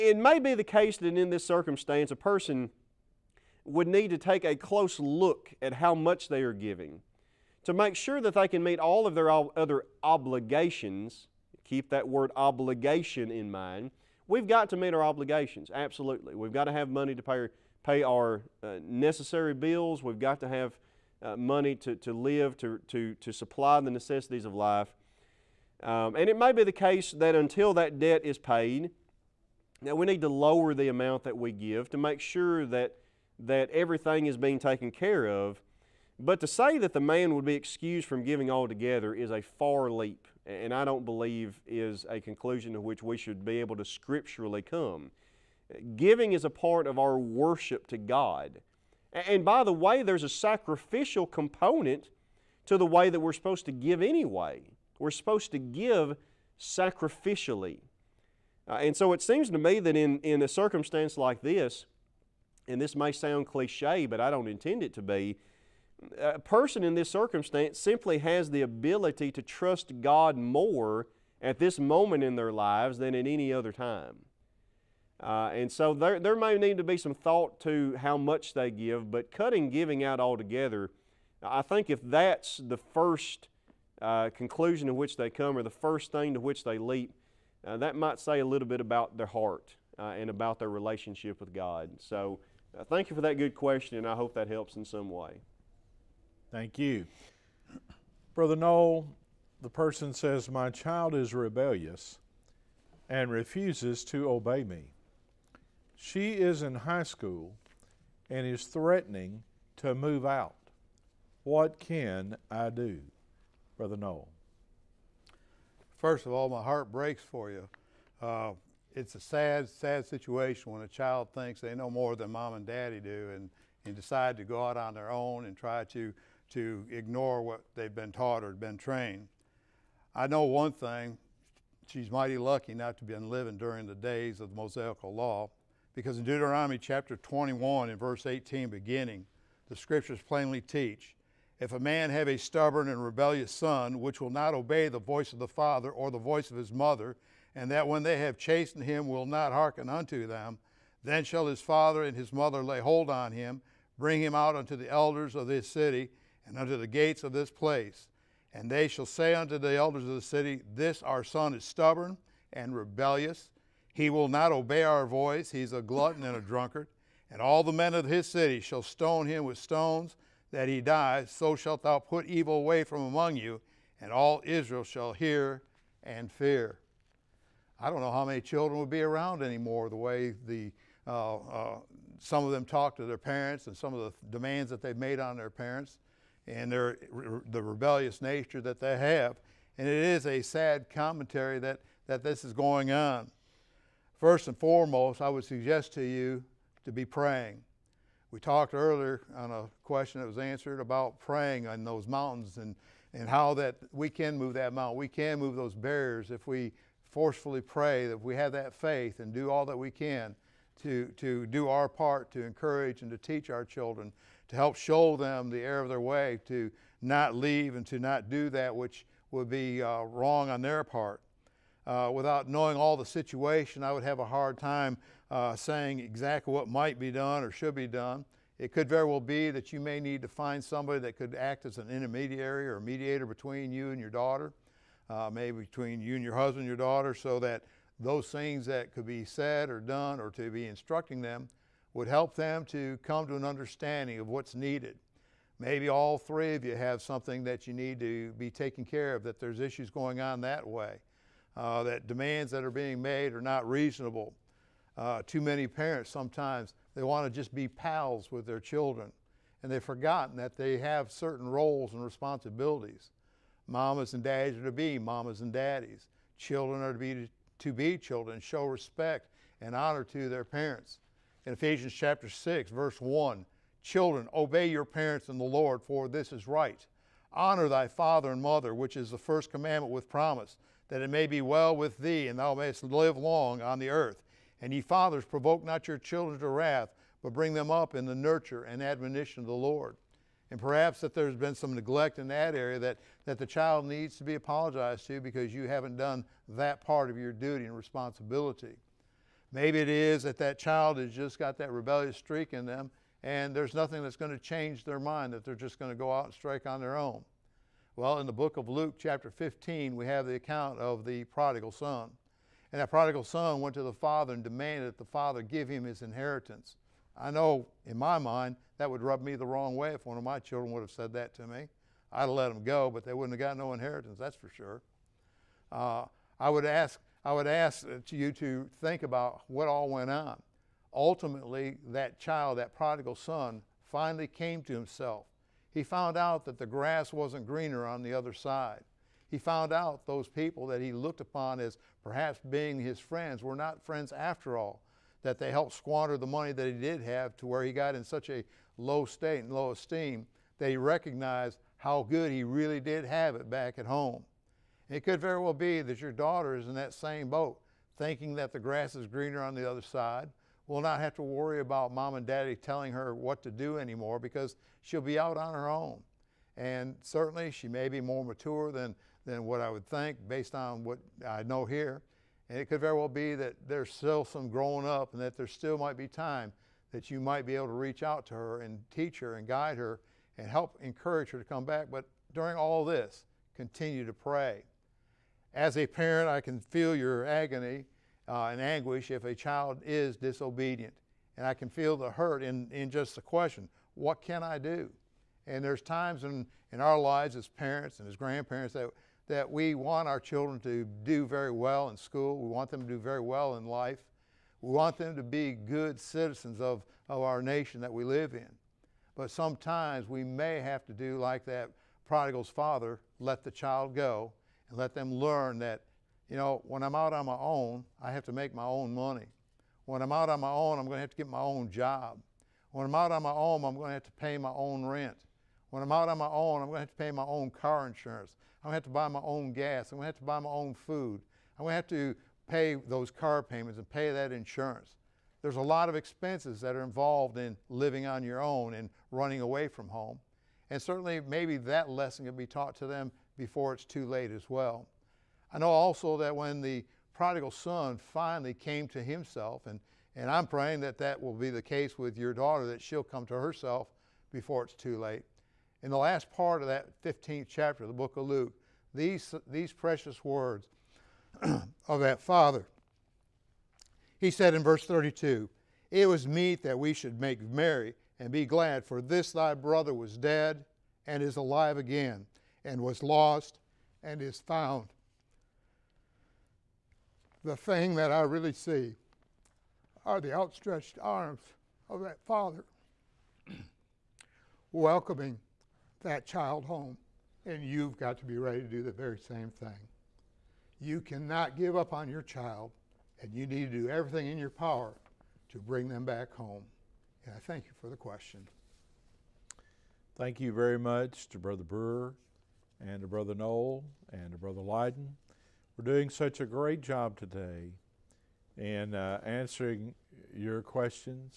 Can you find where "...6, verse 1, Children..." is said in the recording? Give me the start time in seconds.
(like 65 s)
272 s.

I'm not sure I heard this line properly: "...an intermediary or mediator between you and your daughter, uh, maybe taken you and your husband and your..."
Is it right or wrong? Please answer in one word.
wrong.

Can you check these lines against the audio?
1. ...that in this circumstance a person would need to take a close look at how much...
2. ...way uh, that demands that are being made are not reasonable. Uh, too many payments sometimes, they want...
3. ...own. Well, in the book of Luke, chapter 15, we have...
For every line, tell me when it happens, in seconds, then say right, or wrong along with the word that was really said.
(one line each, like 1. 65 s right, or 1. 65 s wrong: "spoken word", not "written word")
1. 0 s right
2. 250 s wrong: "parents", not "payments"
3. 306 s right.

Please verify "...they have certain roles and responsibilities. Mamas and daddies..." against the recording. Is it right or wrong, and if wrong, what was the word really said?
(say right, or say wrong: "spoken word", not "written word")
right.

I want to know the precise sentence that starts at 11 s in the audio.
Keep that word obligation in mind.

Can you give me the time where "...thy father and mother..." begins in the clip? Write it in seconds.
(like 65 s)
277 s.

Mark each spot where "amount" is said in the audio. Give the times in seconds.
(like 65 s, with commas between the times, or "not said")
30 s.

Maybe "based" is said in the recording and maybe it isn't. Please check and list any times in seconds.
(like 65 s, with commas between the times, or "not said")
370 s.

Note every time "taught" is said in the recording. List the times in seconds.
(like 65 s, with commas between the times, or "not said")
128 s, 442 s.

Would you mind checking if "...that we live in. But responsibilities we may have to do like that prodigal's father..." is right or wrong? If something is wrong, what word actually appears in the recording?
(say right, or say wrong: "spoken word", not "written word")
wrong: "sometimes", not "responsibilities".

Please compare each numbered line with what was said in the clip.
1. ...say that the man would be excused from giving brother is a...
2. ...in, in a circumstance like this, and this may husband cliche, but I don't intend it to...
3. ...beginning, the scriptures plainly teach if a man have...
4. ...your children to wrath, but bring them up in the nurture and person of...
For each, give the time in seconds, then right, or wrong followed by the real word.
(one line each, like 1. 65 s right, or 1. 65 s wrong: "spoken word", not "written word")
1. 36 s wrong: "altogether", not "brother"
2. 59 s wrong: "sound", not "husband"
3. 138 s right
4. 285 s wrong: "admonition", not "person".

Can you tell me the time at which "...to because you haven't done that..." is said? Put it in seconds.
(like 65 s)
295 s.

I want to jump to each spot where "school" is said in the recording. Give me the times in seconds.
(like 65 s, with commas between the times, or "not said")
107 s, 401 s.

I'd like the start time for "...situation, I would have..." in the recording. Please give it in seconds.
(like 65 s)
223 s.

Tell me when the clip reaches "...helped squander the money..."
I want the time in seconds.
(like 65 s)
345 s.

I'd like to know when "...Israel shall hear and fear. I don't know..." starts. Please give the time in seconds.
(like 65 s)
174 s.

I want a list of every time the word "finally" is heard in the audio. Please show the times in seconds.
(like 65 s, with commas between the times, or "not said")
333 s, 448 s.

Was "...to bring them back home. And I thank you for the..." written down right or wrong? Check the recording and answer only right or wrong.
right.